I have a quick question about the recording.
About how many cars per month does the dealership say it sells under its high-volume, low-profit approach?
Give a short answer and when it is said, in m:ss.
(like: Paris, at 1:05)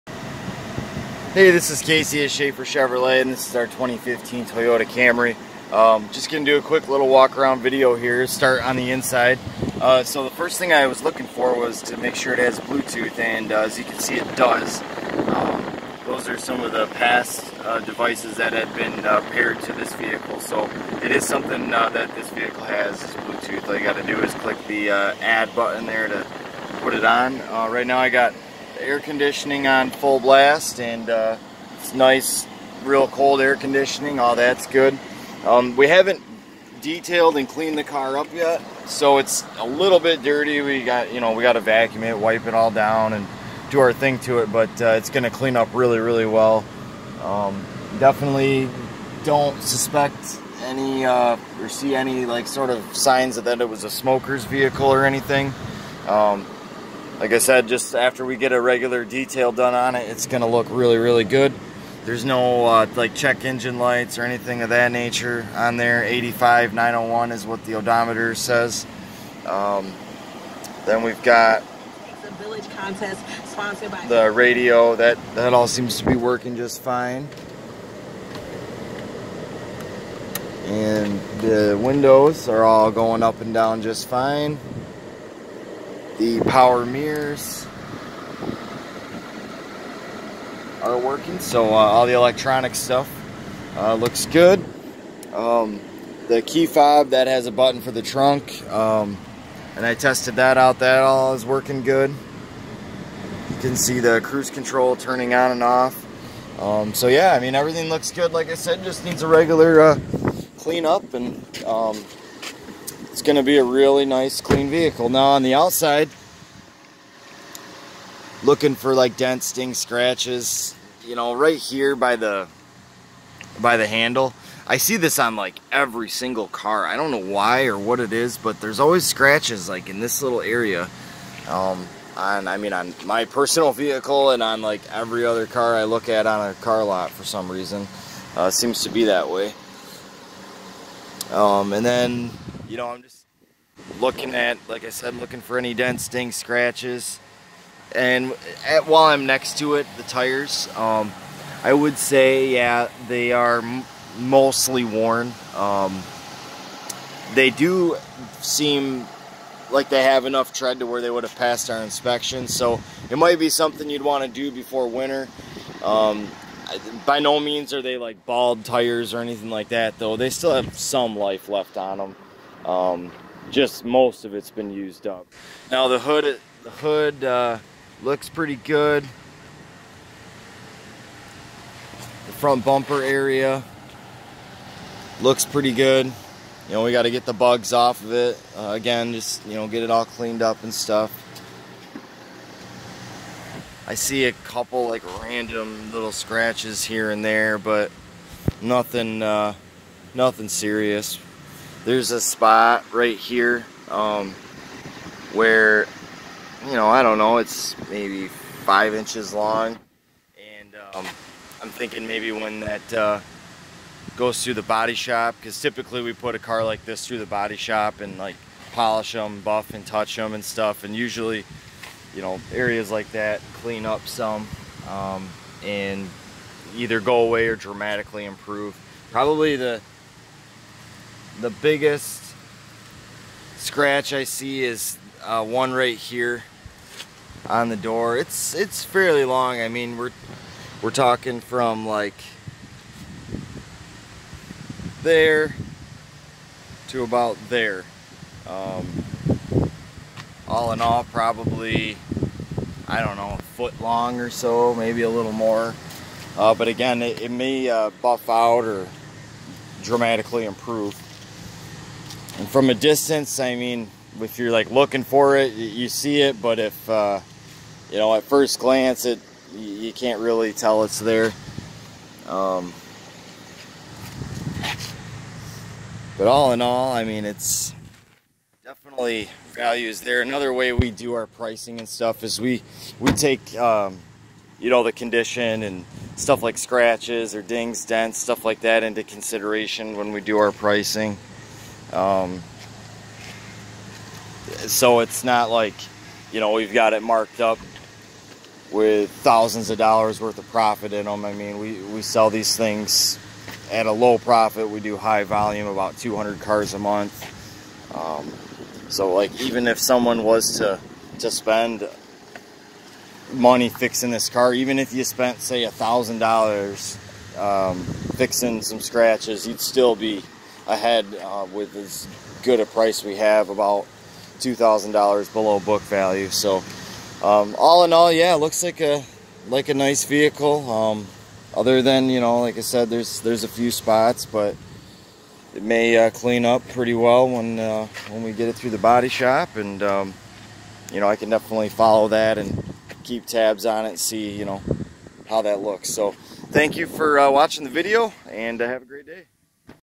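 200, at 5:05.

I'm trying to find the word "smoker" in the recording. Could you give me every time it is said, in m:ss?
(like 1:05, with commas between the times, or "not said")
0:53.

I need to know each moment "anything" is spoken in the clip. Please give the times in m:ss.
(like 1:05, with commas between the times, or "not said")
0:55, 1:04, 2:49.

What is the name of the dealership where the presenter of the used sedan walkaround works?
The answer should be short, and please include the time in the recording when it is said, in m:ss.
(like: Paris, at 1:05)
Schafer Chevrolet, at 0:02.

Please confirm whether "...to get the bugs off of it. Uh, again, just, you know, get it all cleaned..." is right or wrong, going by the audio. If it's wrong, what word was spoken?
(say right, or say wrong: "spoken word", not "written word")
right.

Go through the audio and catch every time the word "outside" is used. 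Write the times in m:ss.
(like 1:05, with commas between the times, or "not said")
1:55.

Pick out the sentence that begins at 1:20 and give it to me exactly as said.
And the windows are all going up and down just fine.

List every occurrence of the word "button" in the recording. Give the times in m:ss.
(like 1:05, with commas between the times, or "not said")
0:25, 1:37.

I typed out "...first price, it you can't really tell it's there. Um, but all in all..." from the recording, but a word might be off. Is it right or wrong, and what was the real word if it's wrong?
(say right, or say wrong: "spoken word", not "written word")
wrong: "glance", not "price".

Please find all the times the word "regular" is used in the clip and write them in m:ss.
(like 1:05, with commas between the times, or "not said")
0:58, 1:49.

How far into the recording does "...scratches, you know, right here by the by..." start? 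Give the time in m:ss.
1:59.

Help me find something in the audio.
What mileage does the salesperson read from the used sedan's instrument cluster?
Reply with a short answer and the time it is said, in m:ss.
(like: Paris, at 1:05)
85,901, at 1:06.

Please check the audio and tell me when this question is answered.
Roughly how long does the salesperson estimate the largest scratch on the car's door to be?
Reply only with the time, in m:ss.
4:13.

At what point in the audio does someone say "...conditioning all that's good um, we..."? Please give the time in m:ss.
0:33.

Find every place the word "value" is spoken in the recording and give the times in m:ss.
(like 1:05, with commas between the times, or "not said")
4:39, 5:25.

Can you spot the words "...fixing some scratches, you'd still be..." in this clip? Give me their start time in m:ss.
5:18.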